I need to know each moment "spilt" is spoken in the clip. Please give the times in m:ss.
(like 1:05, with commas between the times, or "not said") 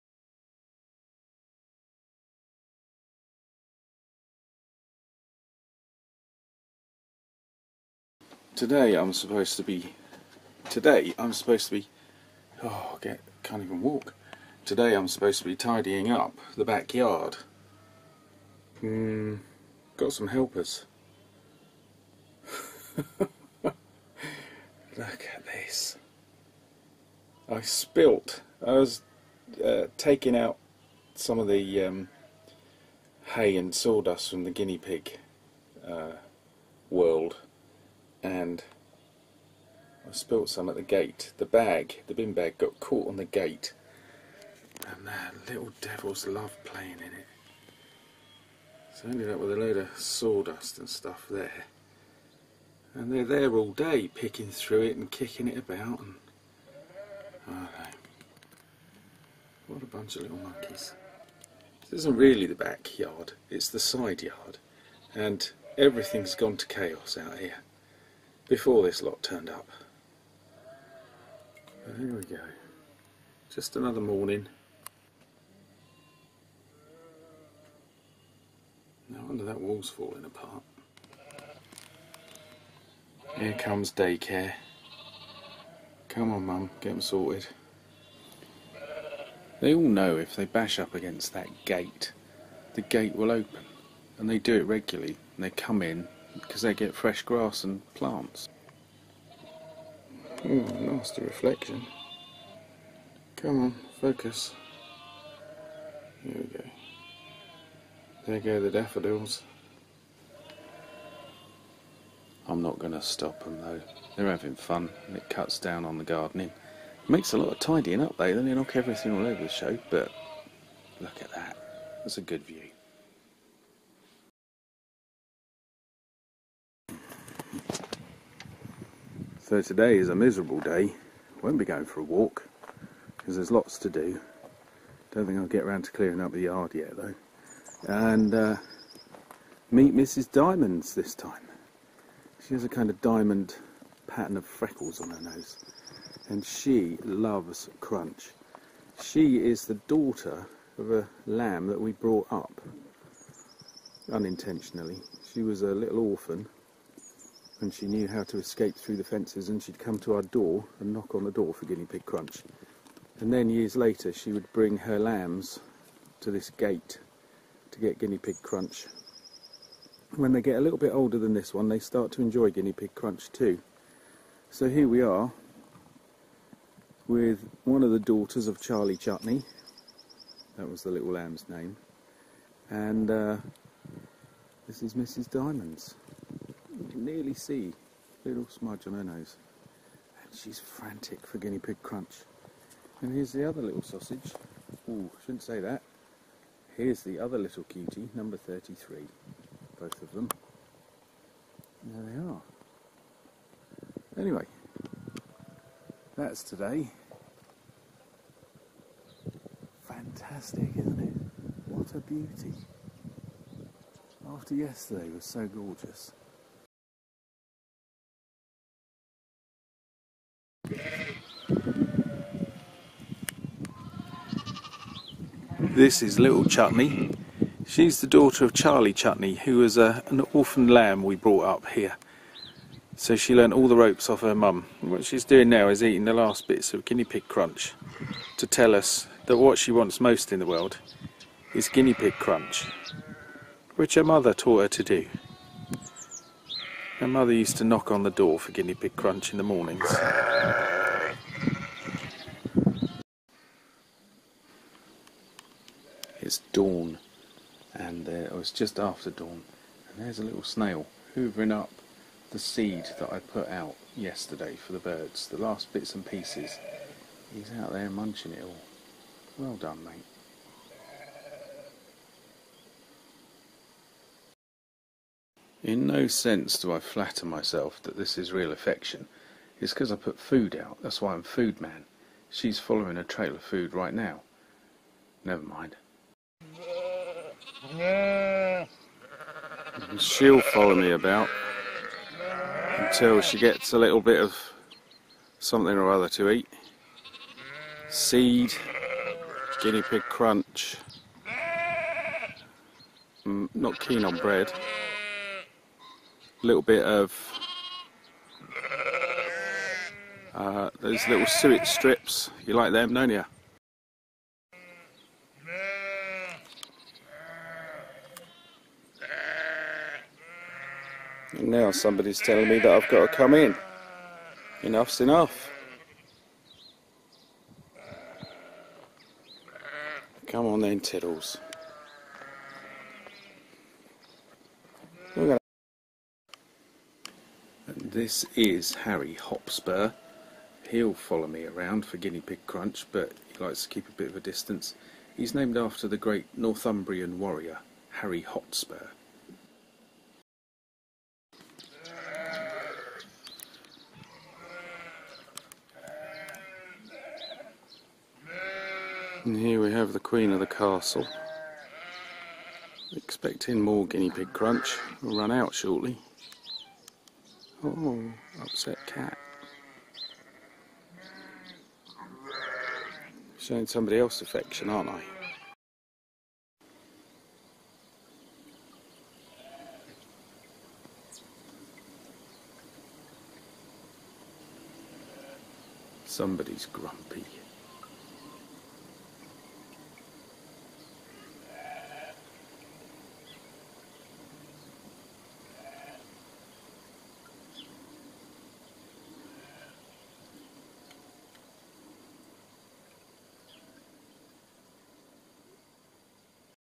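0:27, 0:40.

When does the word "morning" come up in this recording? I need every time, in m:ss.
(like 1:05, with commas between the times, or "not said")
1:14, 4:09.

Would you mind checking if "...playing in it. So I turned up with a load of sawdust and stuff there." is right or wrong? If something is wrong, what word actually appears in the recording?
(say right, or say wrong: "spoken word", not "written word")
wrong: "ended", not "turned".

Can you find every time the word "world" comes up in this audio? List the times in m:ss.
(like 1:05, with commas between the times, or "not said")
0:36, 4:00.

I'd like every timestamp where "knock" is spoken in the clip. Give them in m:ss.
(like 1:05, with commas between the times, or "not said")
1:58, 2:40, 4:07.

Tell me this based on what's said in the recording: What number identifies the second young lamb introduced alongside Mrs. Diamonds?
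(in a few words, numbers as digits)
33.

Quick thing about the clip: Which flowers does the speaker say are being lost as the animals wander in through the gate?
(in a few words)
daffodils.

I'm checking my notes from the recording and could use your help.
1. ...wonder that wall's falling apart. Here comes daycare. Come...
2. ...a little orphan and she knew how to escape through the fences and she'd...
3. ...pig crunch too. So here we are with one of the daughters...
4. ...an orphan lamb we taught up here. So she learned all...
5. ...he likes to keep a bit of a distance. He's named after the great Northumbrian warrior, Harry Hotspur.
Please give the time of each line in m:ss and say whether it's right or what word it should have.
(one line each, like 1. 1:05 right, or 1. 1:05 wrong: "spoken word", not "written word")
1. 1:19 right
2. 2:35 right
3. 2:52 right
4. 3:50 wrong: "brought", not "taught"
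5. 5:43 right.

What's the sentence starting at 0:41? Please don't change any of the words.
The bag, the bin bag, got caught on the gate.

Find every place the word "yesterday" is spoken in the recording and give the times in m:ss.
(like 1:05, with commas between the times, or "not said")
3:34, 4:23.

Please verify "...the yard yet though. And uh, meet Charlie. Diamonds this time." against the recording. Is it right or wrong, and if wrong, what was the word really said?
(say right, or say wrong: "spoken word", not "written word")
wrong: "Mrs", not "Charlie".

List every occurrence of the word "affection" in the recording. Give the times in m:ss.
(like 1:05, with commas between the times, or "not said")
4:38, 6:14.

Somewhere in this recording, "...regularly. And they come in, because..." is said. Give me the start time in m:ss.
1:34.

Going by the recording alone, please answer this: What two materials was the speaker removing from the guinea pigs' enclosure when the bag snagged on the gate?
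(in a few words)
hay and sawdust.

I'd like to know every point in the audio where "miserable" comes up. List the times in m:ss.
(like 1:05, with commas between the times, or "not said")
2:10.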